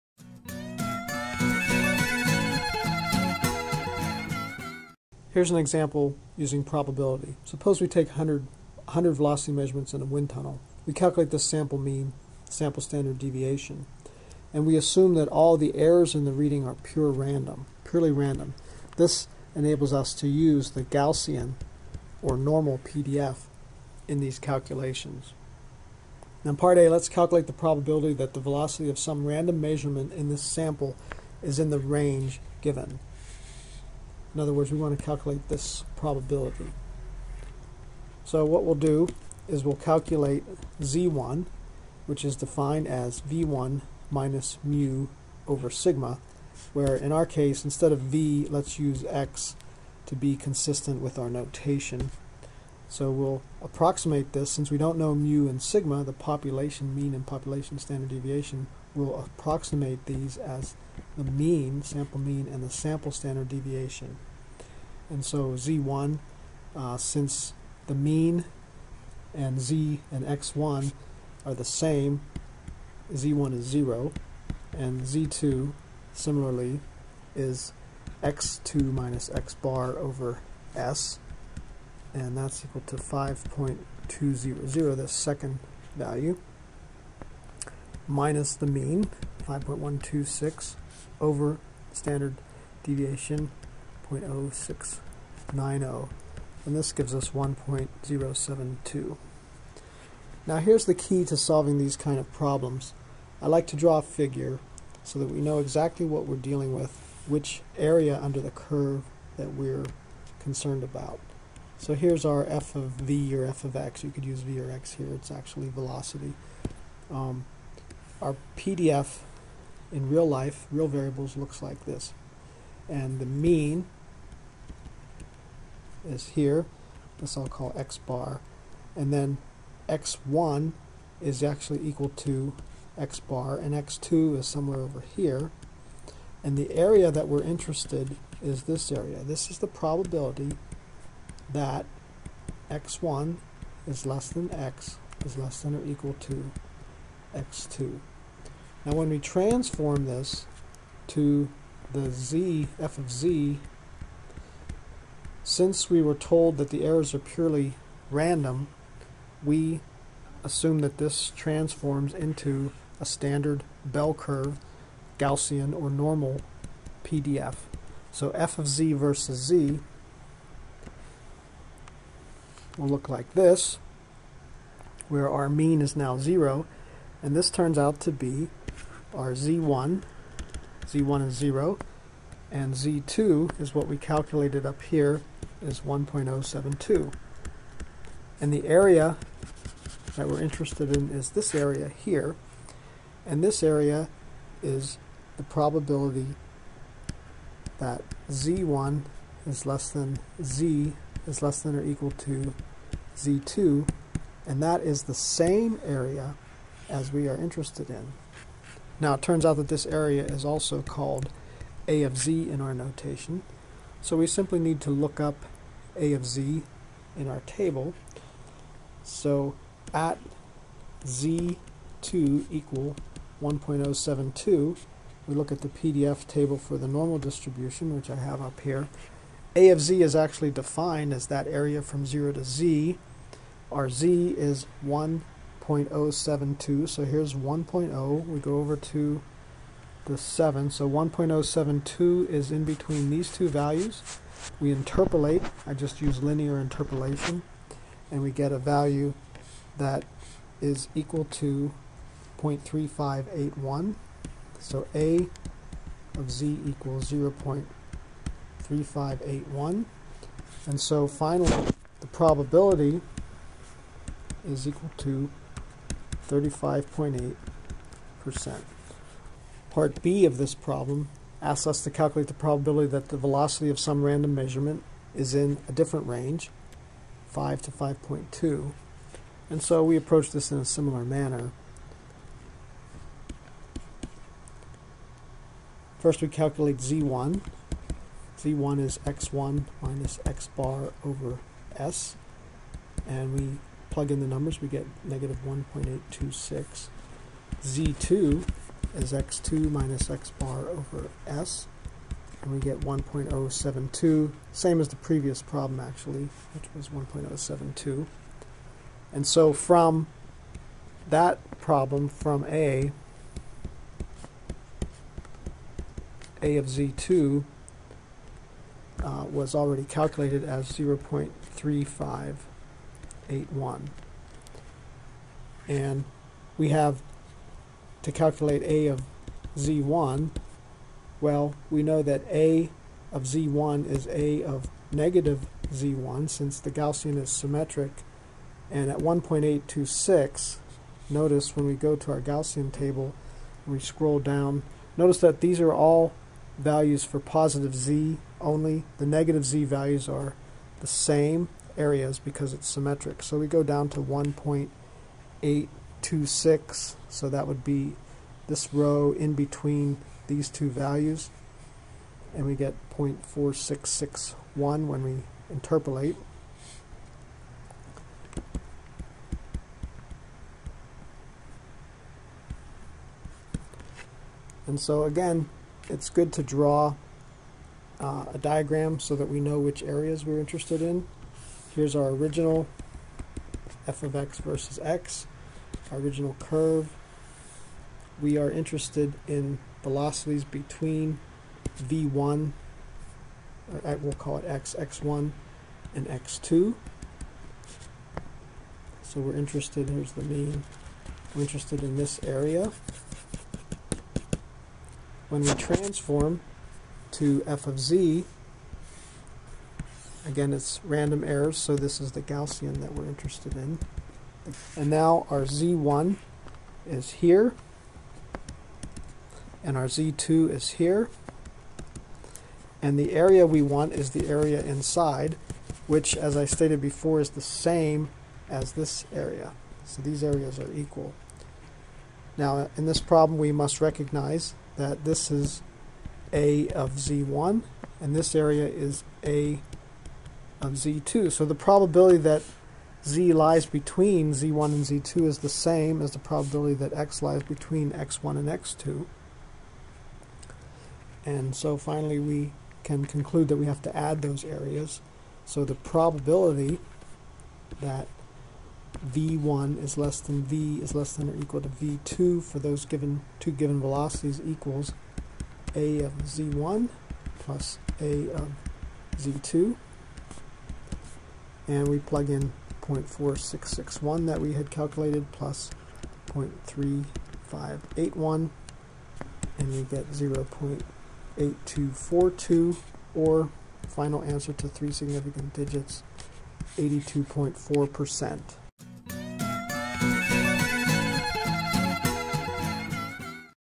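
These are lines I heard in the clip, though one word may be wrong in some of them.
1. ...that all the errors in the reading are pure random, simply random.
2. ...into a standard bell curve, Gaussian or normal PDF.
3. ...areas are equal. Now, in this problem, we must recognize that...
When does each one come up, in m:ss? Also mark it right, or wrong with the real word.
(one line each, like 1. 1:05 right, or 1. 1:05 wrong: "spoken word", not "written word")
1. 0:15 wrong: "purely", not "simply"
2. 2:42 right
3. 7:10 right.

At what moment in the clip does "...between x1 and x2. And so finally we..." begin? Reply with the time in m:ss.
7:27.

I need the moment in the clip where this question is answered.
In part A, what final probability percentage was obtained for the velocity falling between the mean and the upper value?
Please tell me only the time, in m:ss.
4:26.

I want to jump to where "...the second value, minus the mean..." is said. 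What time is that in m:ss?
1:24.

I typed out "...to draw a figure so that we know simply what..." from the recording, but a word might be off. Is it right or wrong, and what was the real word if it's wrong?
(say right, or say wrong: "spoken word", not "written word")
wrong: "exactly", not "simply".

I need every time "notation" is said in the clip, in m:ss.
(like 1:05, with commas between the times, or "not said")
0:51, 3:32.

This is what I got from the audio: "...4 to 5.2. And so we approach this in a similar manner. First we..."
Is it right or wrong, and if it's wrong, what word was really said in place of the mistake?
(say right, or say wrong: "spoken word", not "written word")
wrong: "5", not "4".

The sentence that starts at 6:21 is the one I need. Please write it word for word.
Here's our original f of x versus x, our original curve.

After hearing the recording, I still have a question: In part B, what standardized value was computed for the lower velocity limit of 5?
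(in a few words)
-1.826.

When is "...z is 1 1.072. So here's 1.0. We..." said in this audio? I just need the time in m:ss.
3:53.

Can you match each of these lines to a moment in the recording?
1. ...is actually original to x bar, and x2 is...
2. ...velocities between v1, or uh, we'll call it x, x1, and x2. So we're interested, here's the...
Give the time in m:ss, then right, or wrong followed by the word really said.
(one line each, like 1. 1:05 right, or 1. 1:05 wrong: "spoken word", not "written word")
1. 2:11 wrong: "equal", not "original"
2. 6:29 right.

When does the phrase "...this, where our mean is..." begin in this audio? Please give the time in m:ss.
2:53.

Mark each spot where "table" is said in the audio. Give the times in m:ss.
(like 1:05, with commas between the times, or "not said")
3:37, 3:46, 5:42.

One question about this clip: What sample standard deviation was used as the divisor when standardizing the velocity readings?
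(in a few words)
0.0690.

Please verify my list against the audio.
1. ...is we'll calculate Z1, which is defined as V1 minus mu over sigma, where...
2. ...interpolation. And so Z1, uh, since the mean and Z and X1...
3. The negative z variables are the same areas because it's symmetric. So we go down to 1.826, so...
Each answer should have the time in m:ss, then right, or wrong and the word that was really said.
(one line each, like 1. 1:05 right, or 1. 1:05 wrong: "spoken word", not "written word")
1. 0:39 right
2. 1:03 wrong: "deviation", not "interpolation"
3. 5:48 wrong: "values", not "variables".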